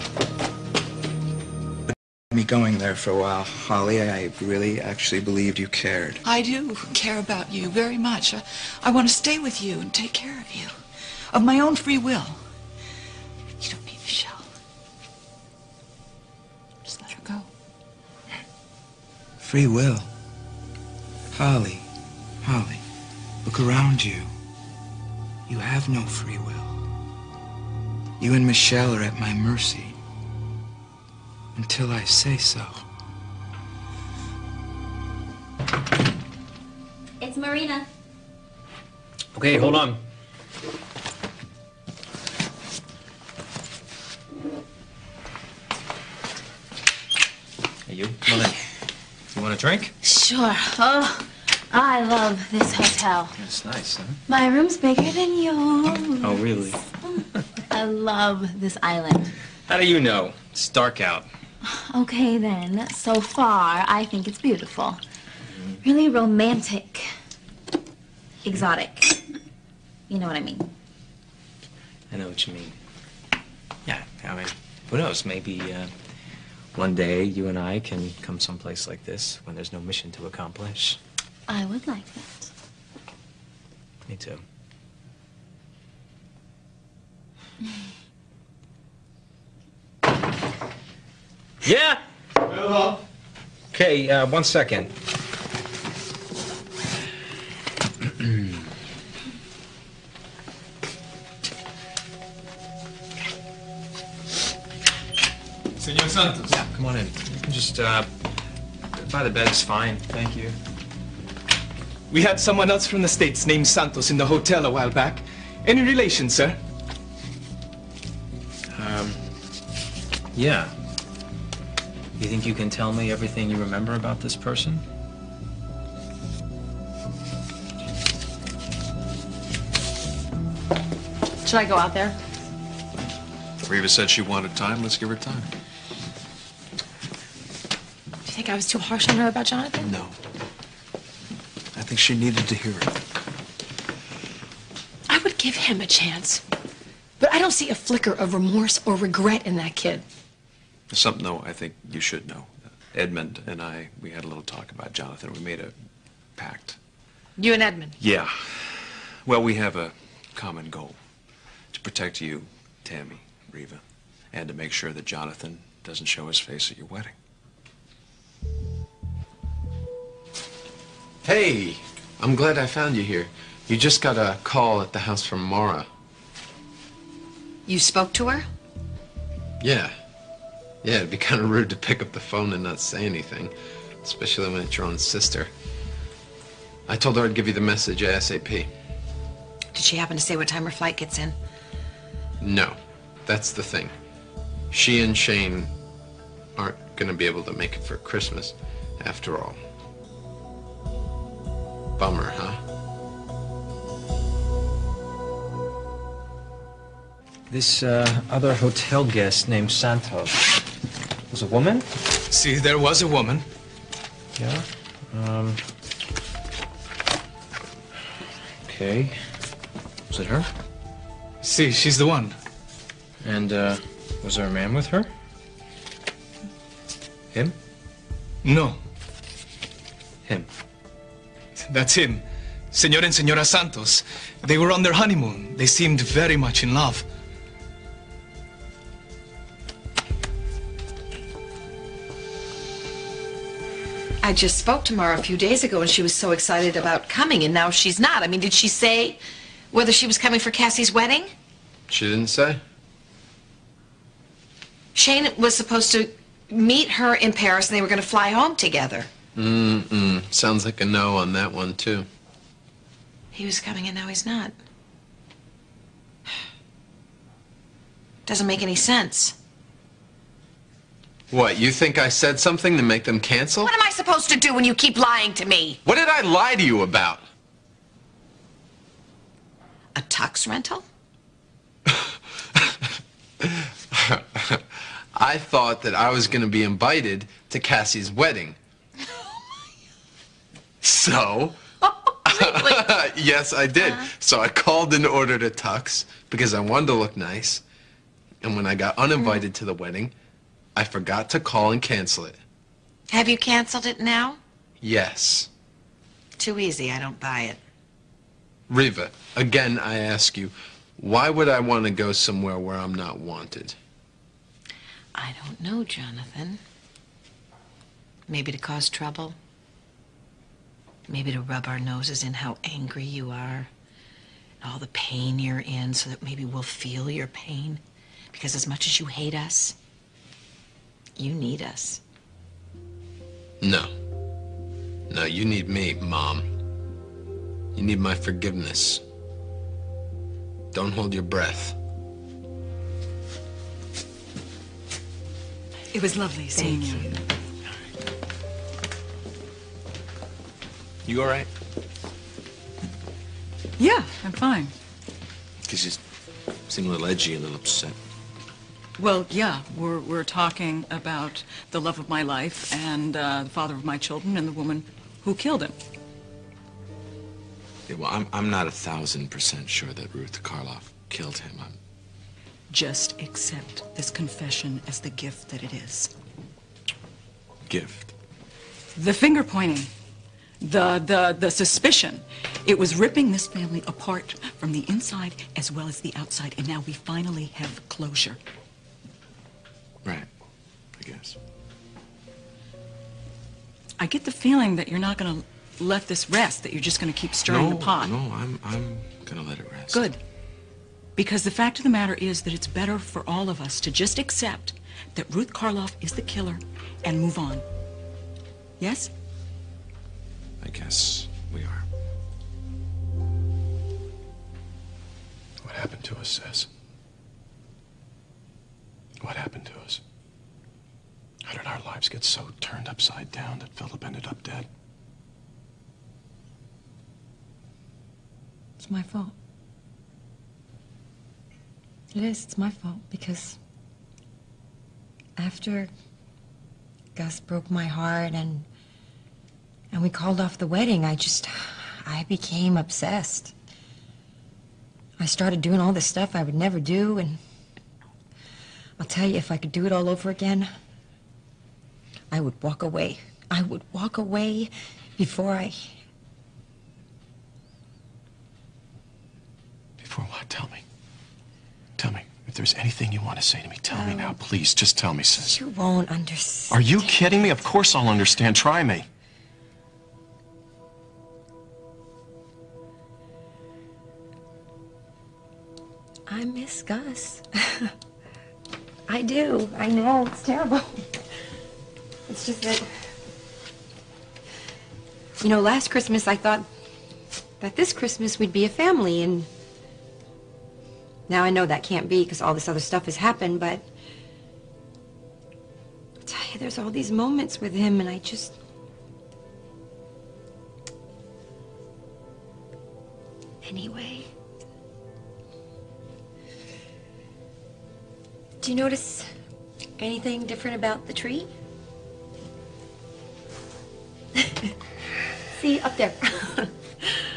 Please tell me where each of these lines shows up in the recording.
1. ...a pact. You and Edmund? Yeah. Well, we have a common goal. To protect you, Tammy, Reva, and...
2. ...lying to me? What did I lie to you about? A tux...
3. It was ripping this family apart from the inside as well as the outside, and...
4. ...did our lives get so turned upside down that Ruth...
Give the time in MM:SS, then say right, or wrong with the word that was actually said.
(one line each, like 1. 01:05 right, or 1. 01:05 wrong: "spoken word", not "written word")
1. 02:35 right
2. 04:34 right
3. 06:22 right
4. 07:01 wrong: "Philip", not "Ruth".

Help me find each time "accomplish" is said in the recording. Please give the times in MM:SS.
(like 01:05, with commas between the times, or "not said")
01:20.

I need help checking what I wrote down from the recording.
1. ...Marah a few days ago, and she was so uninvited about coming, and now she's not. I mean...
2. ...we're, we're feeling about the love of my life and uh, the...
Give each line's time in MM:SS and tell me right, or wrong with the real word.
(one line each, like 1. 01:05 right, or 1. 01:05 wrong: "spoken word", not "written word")
1. 04:04 wrong: "excited", not "uninvited"
2. 05:59 wrong: "talking", not "feeling".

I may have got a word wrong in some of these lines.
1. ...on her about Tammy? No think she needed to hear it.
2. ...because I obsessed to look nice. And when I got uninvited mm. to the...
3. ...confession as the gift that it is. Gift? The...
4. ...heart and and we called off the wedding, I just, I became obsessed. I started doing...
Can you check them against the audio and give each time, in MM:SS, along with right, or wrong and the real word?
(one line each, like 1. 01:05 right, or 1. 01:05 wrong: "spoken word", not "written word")
1. 02:19 wrong: "Jonathan", not "Tammy"
2. 04:56 wrong: "wanted", not "obsessed"
3. 06:14 right
4. 07:17 right.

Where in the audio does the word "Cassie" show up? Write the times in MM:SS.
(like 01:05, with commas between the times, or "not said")
04:10, 04:47.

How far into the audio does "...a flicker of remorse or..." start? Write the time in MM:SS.
02:27.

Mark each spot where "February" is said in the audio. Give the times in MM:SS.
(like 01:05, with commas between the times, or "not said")
not said.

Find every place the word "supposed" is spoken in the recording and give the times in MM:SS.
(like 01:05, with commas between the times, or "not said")
04:15, 04:33.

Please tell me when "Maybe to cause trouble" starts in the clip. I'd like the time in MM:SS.
05:18.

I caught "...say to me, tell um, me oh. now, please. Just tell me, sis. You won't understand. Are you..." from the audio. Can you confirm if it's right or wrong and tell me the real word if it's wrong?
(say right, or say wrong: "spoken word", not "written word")
right.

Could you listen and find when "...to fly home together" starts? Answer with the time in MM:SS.
04:18.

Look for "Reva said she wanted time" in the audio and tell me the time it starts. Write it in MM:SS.
02:13.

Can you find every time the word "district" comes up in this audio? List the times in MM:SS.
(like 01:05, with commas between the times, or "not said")
not said.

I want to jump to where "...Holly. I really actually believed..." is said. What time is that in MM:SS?
00:03.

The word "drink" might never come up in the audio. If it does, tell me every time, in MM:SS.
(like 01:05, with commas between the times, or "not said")
00:49.